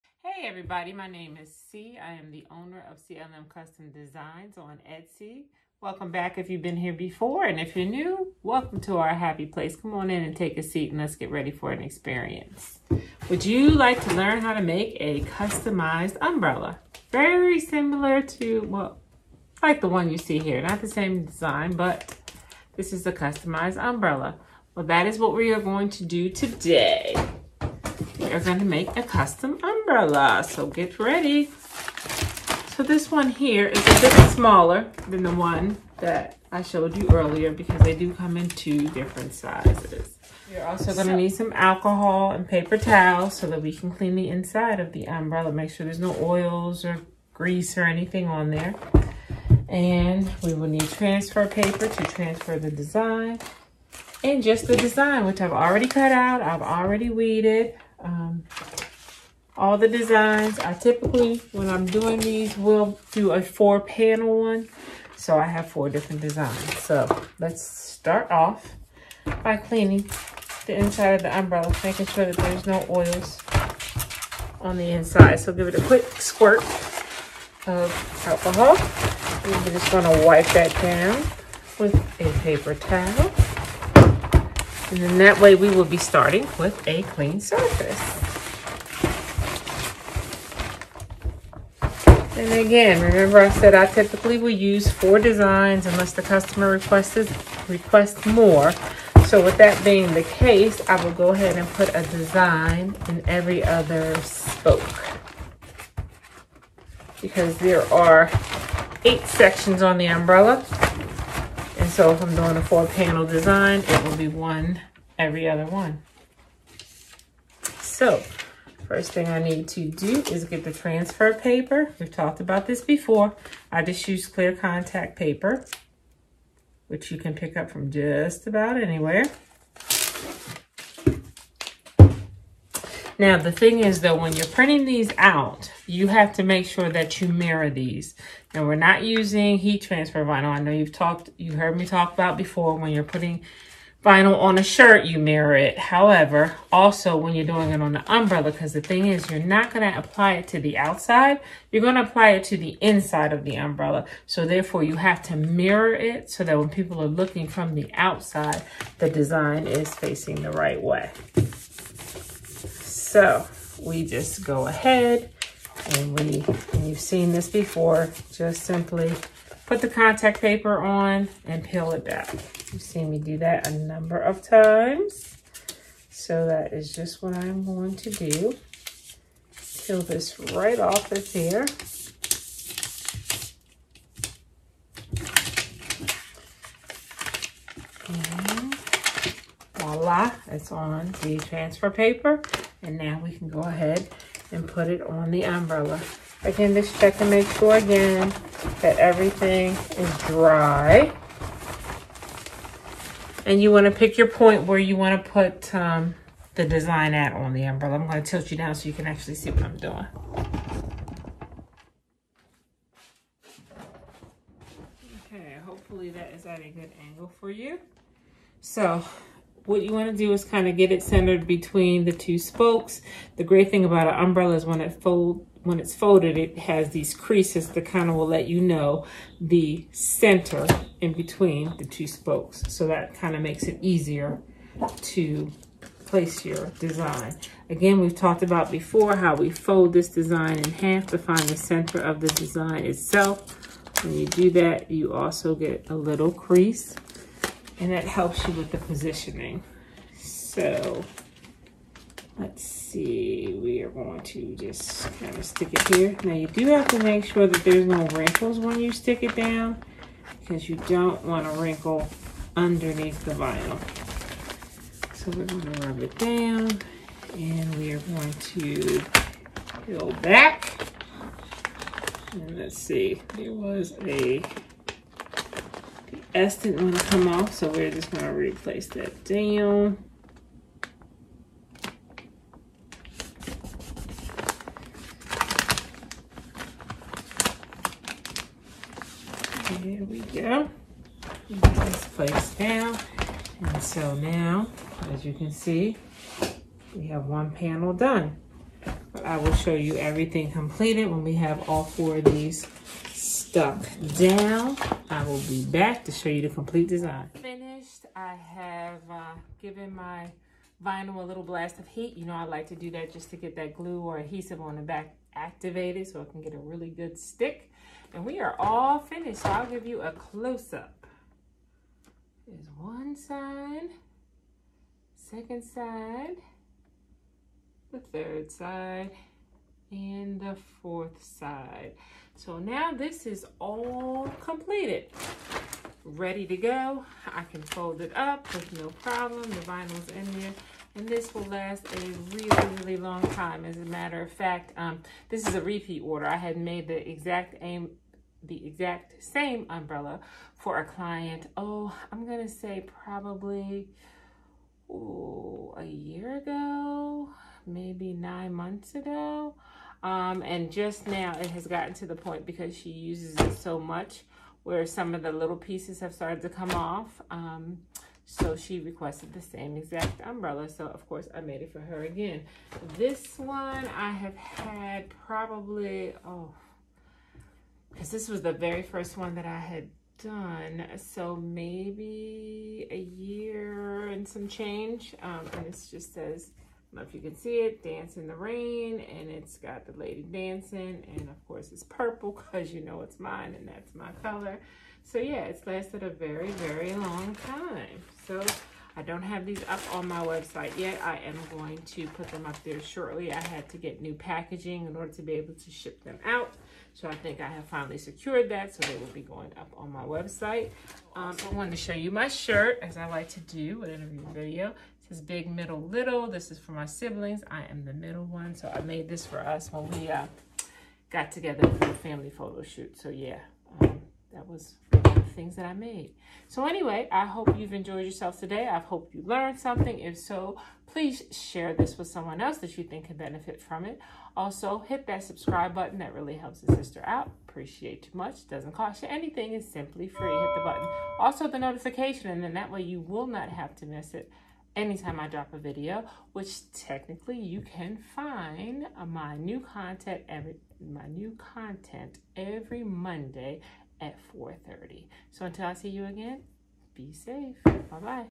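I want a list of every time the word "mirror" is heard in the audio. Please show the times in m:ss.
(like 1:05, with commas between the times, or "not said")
2:17, 2:25, 2:35.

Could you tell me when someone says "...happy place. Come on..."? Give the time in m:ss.
0:09.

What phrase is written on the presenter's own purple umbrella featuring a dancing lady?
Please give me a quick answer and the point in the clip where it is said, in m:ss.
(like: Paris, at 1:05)
Dance in the Rain, at 6:27.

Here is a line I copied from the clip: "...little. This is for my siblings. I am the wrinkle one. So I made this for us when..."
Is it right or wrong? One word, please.
wrong.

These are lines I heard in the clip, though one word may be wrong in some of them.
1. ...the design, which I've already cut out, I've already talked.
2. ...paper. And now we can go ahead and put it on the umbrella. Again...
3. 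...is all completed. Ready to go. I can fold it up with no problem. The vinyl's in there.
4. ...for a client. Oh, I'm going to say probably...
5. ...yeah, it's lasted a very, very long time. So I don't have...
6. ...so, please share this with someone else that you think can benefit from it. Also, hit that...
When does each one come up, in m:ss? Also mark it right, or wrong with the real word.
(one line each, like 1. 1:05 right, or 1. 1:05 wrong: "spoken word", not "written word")
1. 0:54 wrong: "weeded", not "talked"
2. 3:11 right
3. 5:33 right
4. 5:50 right
5. 6:35 right
6. 7:10 right.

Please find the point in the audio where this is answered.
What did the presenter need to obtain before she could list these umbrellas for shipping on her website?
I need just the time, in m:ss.
6:44.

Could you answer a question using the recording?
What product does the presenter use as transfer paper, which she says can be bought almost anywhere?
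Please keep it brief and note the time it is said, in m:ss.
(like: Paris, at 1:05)
clear contact paper, at 2:04.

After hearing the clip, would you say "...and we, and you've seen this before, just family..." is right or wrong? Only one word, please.
wrong.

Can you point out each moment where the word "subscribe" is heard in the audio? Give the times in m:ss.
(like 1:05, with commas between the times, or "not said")
7:15.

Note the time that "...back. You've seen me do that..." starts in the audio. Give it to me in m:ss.
2:52.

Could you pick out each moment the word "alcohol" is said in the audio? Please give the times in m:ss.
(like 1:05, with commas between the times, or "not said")
0:41, 1:18.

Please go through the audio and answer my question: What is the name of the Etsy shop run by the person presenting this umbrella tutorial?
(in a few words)
CLM Custom Designs.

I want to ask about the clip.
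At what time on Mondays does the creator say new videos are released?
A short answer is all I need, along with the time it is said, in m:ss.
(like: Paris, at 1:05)
4:30, at 7:34.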